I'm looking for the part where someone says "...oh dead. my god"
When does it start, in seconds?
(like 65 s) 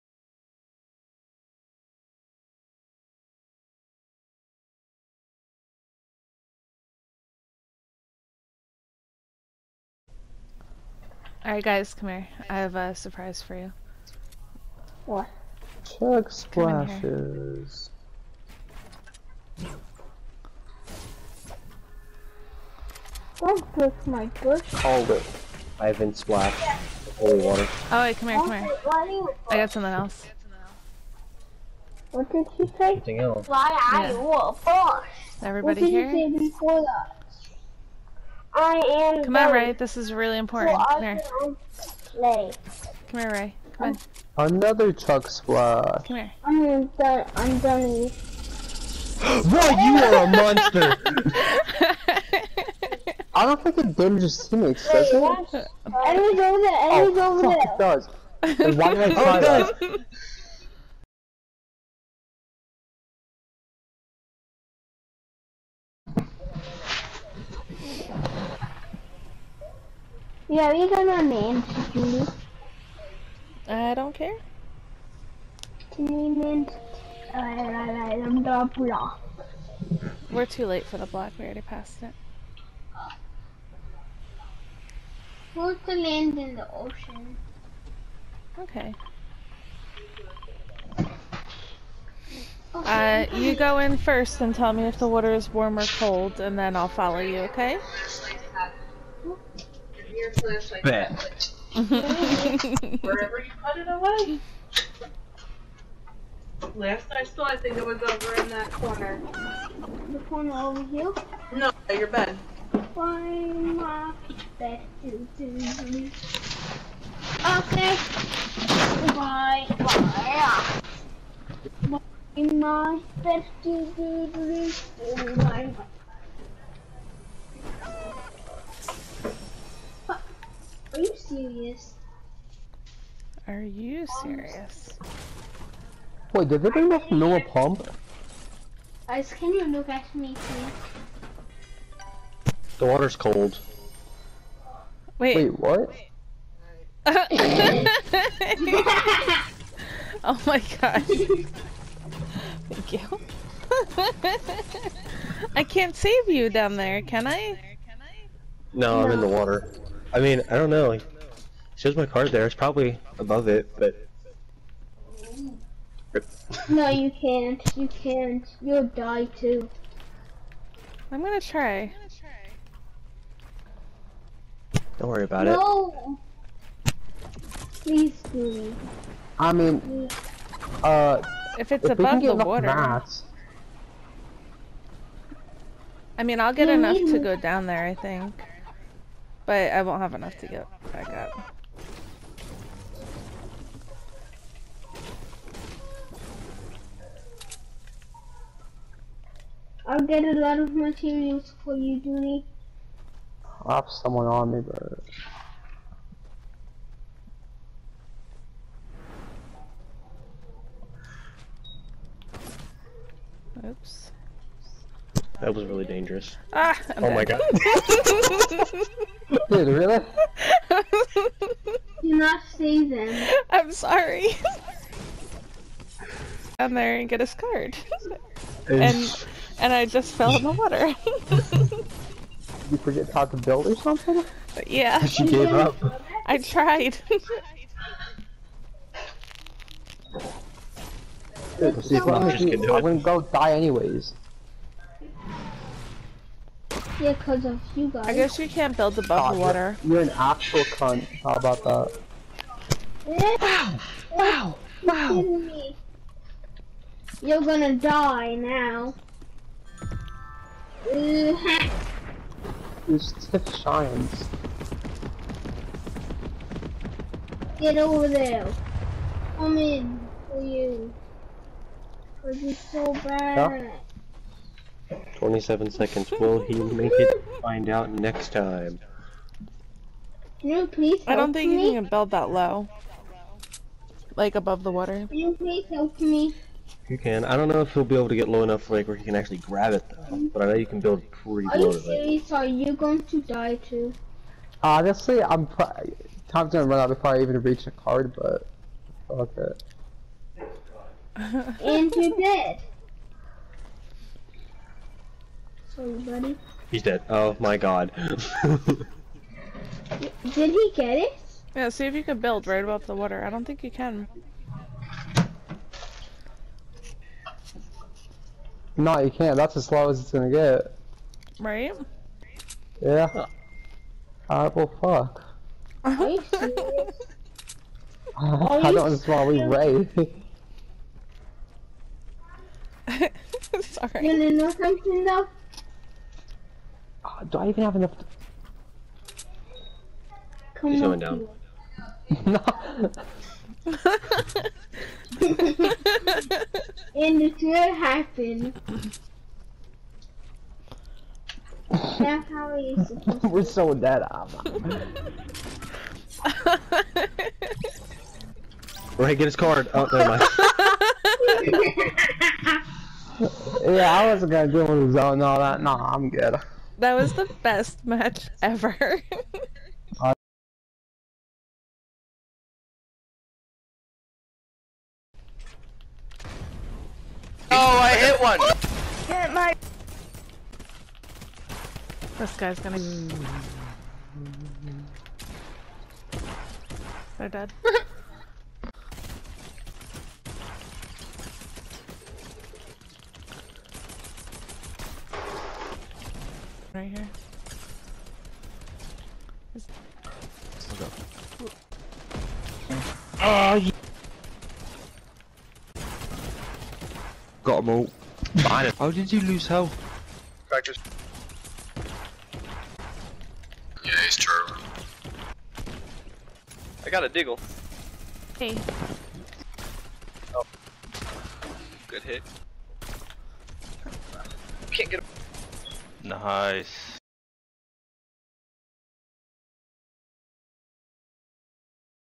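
217 s.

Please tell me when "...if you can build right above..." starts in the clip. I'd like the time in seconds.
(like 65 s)
311 s.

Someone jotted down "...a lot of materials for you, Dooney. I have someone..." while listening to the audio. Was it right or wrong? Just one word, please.
right.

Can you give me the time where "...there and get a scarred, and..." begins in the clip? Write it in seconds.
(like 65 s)
226 s.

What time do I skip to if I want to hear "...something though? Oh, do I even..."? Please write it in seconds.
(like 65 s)
334 s.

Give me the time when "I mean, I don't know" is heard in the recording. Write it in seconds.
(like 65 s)
160 s.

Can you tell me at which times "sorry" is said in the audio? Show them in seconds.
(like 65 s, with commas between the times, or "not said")
223 s, 333 s.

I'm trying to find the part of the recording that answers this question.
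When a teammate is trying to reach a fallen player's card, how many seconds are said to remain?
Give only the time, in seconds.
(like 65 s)
275 s.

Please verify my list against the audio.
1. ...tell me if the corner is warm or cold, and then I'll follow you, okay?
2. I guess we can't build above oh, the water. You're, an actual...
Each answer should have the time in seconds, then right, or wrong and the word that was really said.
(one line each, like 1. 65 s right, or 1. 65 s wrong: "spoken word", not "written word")
1. 94 s wrong: "water", not "corner"
2. 248 s right.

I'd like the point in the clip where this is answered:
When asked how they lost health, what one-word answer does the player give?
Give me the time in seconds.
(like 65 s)
410 s.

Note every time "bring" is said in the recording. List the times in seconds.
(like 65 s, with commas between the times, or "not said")
136 s.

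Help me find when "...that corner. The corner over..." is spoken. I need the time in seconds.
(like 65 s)
108 s.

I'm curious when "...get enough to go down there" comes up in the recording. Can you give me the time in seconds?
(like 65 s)
186 s.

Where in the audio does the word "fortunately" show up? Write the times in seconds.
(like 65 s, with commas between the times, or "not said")
not said.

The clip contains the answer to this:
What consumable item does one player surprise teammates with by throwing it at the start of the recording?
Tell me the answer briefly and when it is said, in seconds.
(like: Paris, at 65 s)
Chug Splashes, at 15 s.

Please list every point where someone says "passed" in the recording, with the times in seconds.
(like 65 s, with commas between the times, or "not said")
81 s.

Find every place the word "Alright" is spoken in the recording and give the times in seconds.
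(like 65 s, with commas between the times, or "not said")
11 s, 324 s.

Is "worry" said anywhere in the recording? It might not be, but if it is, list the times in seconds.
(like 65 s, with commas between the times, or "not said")
175 s.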